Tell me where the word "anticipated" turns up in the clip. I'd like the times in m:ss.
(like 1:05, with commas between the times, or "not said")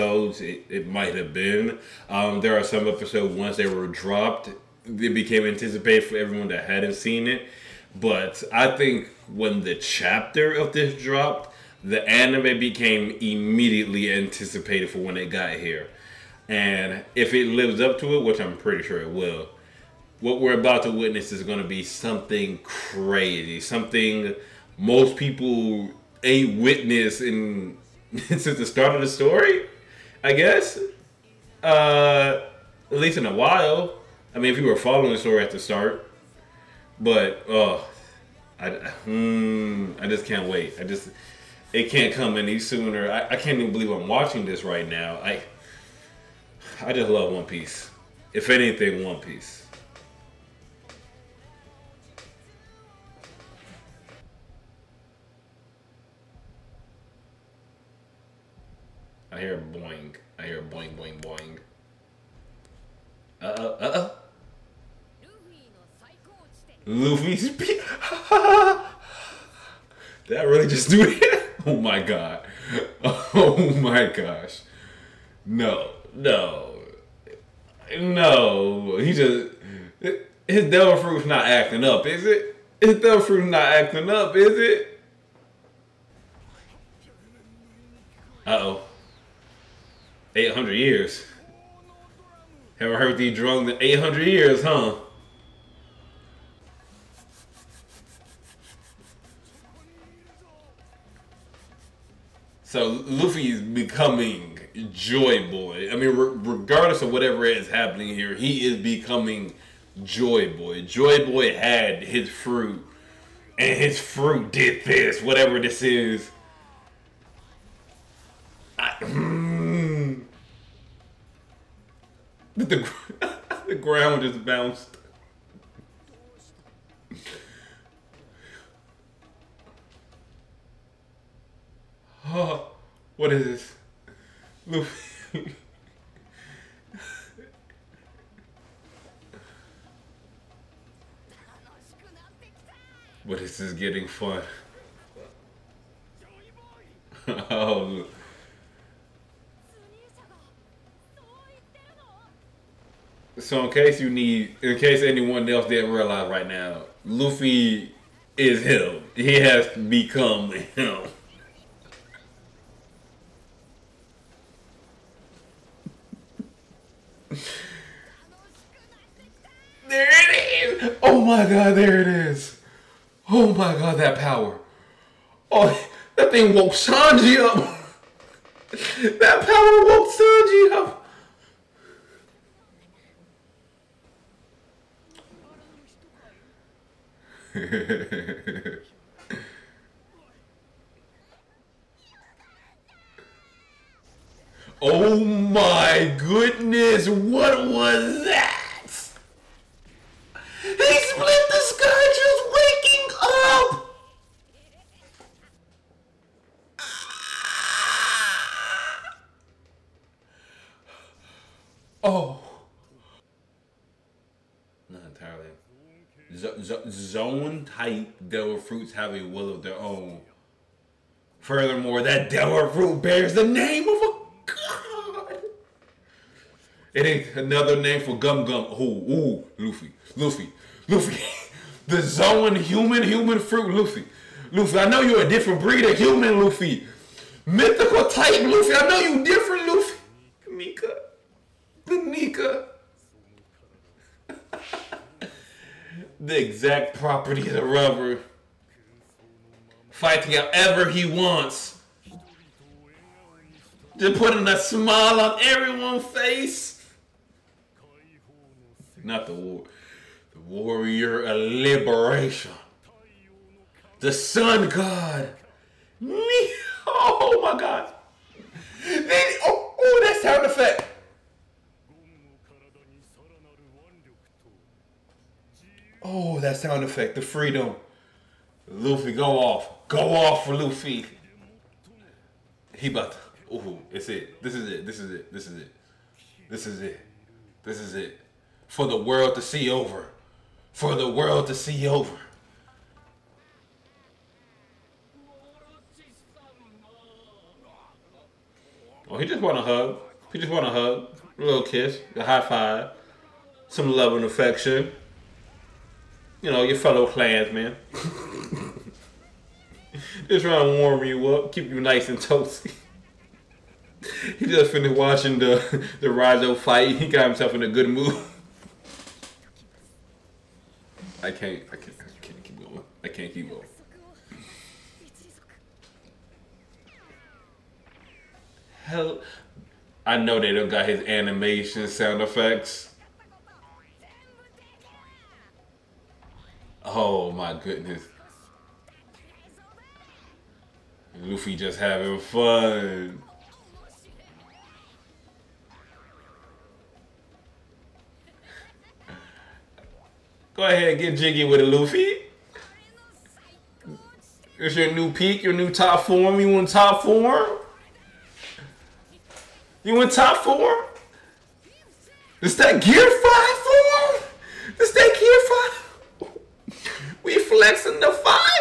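0:05, 0:14.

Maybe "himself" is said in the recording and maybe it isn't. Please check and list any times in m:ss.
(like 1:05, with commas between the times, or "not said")
5:17.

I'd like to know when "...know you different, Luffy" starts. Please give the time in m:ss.
3:58.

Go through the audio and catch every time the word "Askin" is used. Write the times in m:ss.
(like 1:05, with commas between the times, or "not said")
not said.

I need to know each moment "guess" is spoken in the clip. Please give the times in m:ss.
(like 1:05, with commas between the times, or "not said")
0:30.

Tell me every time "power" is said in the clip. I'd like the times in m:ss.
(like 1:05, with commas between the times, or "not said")
2:54, 2:59.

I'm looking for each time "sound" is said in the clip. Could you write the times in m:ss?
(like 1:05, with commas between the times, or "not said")
4:30, 4:36, 5:31.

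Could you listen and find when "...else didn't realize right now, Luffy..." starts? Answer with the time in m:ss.
2:35.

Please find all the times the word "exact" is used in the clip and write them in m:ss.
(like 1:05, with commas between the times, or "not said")
4:06.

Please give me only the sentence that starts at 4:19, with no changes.
Not the war, the warrior of liberation, the sun god.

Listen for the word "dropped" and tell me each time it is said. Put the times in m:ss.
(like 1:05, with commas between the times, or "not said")
0:03, 0:10.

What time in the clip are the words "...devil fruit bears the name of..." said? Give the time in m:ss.
3:42.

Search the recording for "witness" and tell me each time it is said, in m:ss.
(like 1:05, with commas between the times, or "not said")
0:20, 0:26.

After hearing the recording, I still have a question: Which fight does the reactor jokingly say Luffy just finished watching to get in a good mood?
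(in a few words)
the Rizzo fight.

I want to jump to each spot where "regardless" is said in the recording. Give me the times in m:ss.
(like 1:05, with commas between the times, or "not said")
1:46.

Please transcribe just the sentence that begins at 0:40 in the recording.
I just it can't come any sooner.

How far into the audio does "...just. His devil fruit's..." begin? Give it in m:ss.
1:19.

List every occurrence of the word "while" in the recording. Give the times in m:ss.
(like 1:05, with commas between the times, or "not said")
0:33.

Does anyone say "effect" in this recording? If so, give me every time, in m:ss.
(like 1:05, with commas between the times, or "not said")
4:30, 4:36, 5:32.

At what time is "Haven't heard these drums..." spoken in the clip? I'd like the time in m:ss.
1:32.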